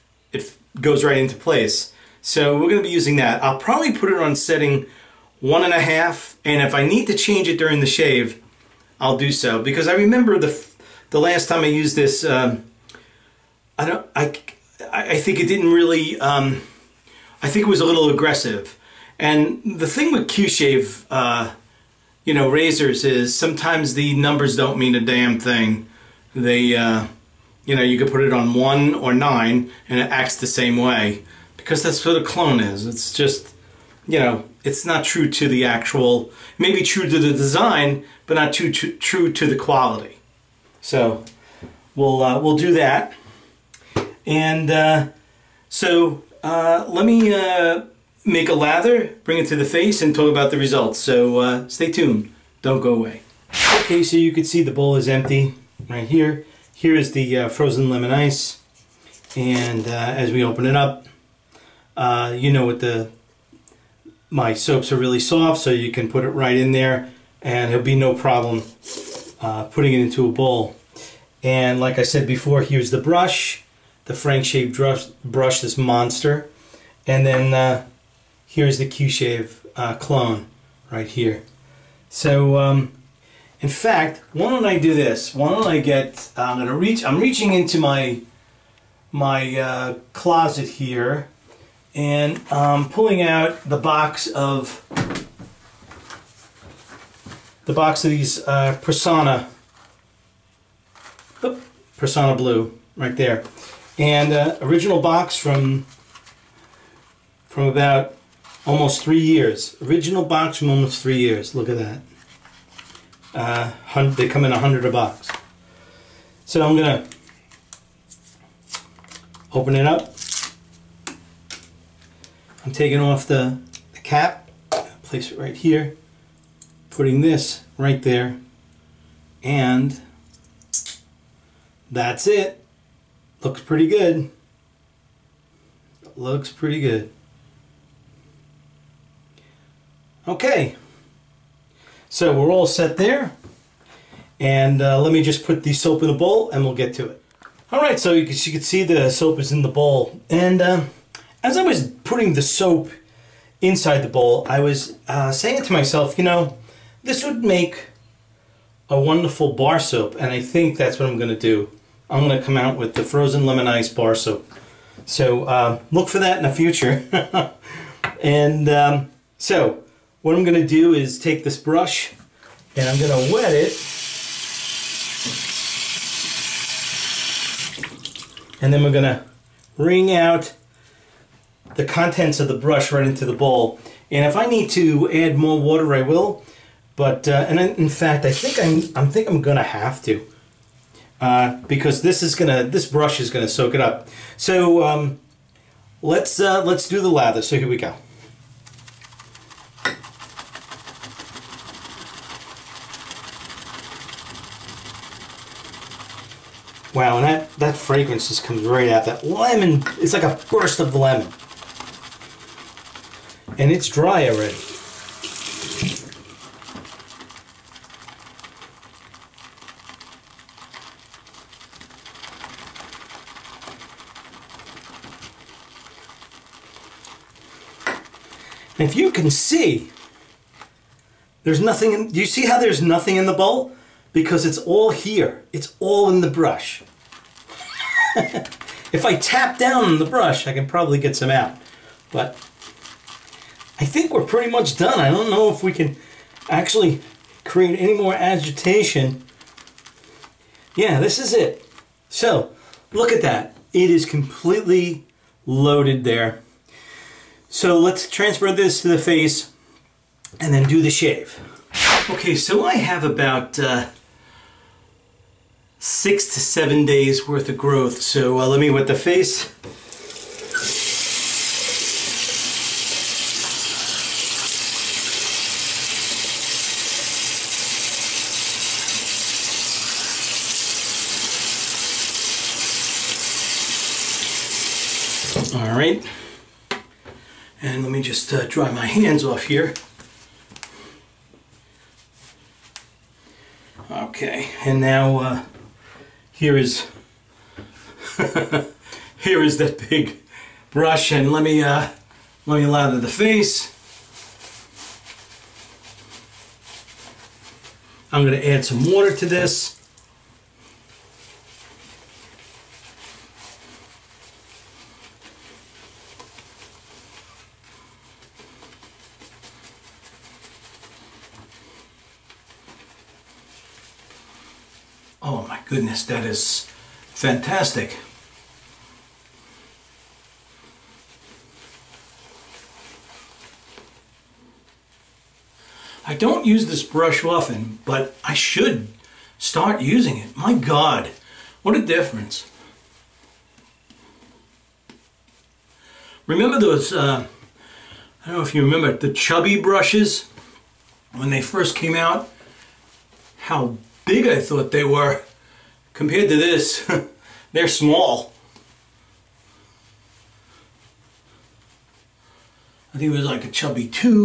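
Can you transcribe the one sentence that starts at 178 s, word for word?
And then we're going to wring out the contents of the brush right into the bowl.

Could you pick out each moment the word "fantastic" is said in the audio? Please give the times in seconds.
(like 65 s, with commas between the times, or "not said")
327 s.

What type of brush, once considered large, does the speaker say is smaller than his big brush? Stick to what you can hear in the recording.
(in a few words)
Chubby brushes.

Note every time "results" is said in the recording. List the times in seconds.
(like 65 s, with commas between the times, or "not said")
50 s.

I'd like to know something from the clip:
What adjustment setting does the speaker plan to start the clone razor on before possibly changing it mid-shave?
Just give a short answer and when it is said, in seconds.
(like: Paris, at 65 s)
1.5, at 5 s.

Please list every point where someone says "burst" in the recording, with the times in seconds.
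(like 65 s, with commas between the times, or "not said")
210 s.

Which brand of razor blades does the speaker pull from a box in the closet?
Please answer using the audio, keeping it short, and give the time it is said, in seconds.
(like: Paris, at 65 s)
Personna Blue, at 98 s.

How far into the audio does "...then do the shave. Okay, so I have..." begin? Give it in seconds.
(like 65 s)
260 s.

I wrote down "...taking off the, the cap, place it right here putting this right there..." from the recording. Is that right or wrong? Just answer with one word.
right.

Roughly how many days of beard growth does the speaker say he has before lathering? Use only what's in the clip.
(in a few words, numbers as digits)
6 to 7 days.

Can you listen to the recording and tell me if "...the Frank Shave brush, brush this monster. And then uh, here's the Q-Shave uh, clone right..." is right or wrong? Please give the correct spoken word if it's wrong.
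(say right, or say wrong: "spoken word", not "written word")
right.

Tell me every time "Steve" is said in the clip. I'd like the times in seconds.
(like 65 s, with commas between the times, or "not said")
not said.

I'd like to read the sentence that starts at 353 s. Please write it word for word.
How big I thought they were.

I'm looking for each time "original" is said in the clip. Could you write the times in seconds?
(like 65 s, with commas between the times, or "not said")
104 s, 109 s.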